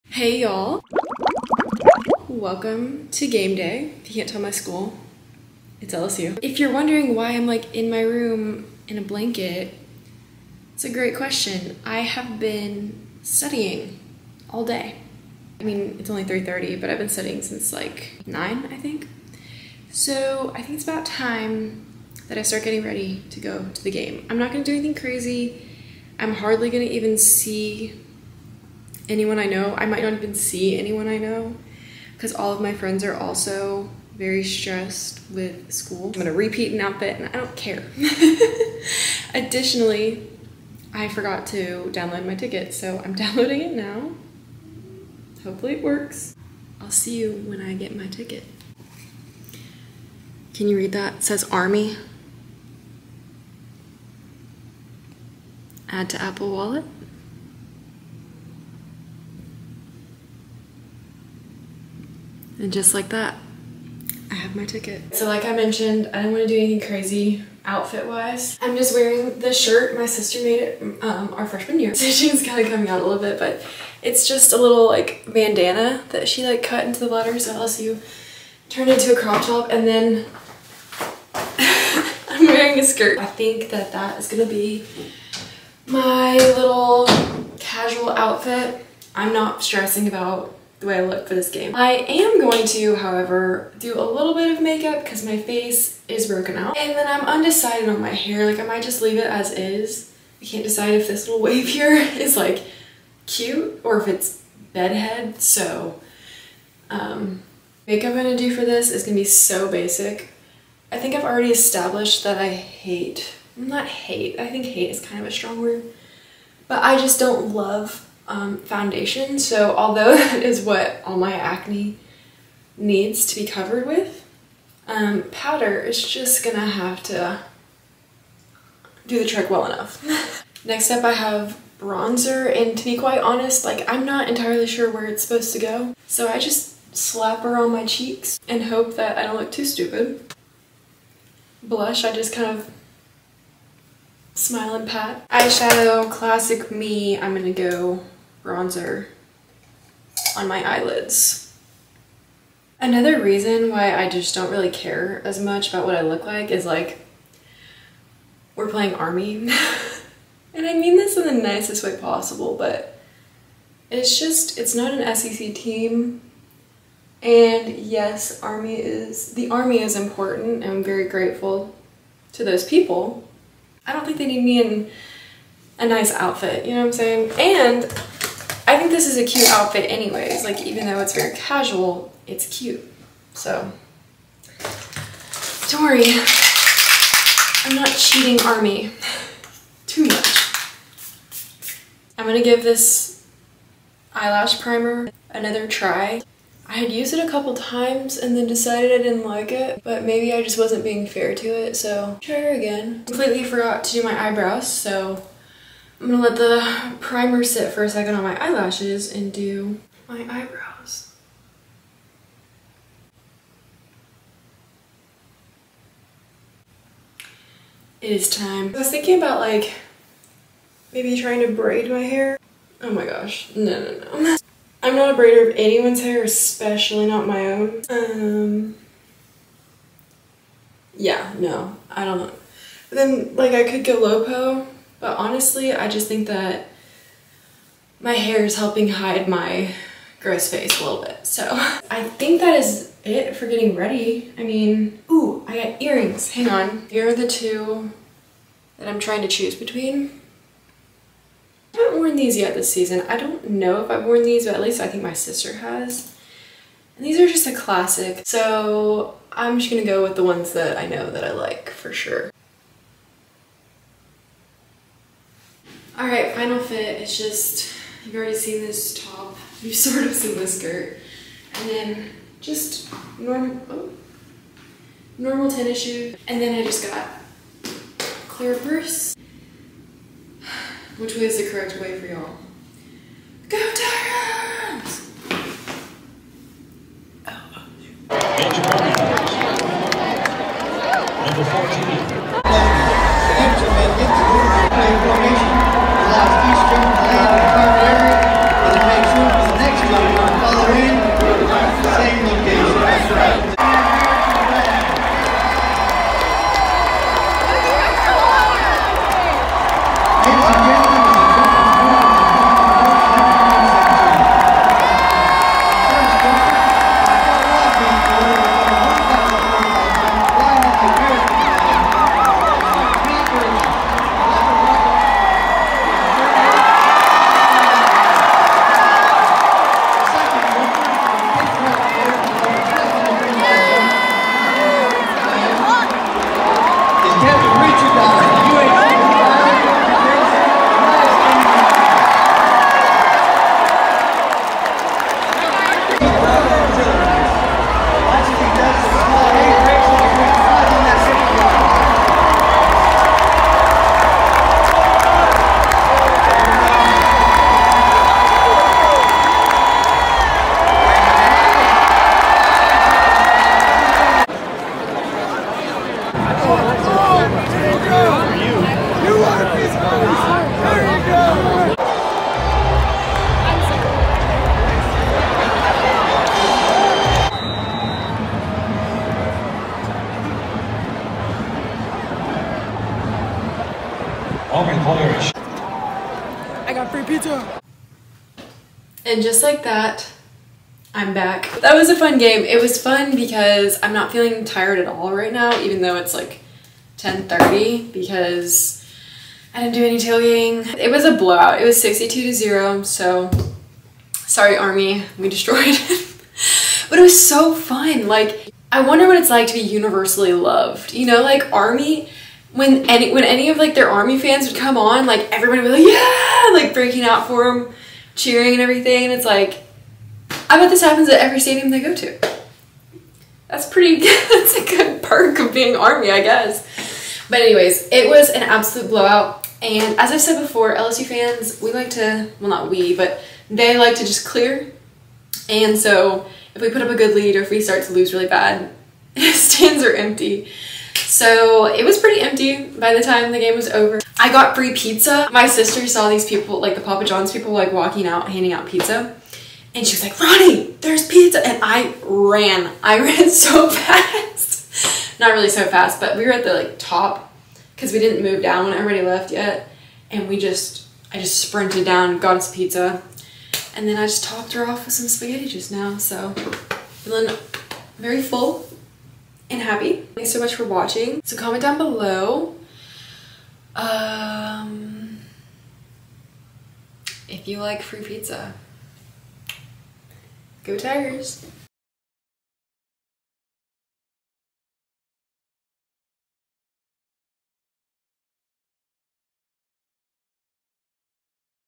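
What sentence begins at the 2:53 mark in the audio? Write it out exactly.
I don't think they need me in a nice outfit, you know what I'm saying?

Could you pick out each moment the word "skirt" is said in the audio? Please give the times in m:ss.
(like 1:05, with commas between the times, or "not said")
1:22, 4:30.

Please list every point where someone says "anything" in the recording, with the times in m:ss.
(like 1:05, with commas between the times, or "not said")
0:24, 1:06.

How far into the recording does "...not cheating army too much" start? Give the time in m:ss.
3:07.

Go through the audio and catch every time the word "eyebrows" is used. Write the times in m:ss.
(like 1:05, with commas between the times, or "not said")
3:24, 3:30.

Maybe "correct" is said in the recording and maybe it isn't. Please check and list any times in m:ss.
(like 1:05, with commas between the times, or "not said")
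4:41.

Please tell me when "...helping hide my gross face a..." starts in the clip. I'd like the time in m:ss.
3:58.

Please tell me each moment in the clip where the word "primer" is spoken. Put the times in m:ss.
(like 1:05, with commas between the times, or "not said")
3:14, 3:26.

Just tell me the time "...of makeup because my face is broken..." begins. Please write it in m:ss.
1:34.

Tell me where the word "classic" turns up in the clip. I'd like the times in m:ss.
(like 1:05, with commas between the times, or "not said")
2:26, 4:17.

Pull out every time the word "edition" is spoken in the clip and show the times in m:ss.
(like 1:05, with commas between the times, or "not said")
not said.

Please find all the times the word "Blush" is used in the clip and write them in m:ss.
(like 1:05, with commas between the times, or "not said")
2:21.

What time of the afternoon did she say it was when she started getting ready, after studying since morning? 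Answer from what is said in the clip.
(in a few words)
3:30.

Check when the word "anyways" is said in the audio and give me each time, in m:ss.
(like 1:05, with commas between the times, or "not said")
2:59, 7:07.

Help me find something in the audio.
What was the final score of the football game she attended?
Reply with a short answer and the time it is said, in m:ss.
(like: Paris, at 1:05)
62 to 0, at 6:41.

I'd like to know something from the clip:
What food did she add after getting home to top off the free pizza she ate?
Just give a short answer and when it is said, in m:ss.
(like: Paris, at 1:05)
Spaghetti, at 7:45.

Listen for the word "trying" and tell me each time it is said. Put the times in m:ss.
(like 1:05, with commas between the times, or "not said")
3:41, 4:08.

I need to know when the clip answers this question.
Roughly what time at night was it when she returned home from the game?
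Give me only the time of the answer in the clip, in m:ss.
6:36.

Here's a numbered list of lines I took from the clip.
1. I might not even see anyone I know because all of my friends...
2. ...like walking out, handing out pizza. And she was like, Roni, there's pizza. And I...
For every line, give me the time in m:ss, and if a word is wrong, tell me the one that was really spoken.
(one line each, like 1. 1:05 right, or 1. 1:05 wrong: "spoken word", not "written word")
1. 0:29 right
2. 7:27 right.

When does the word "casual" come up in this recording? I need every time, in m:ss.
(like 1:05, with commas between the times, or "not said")
1:27, 3:01.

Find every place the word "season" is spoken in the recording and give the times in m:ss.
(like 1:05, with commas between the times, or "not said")
4:12.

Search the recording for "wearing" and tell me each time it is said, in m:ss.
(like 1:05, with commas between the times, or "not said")
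1:08, 1:22.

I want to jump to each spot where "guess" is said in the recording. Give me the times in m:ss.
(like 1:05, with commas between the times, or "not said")
7:06.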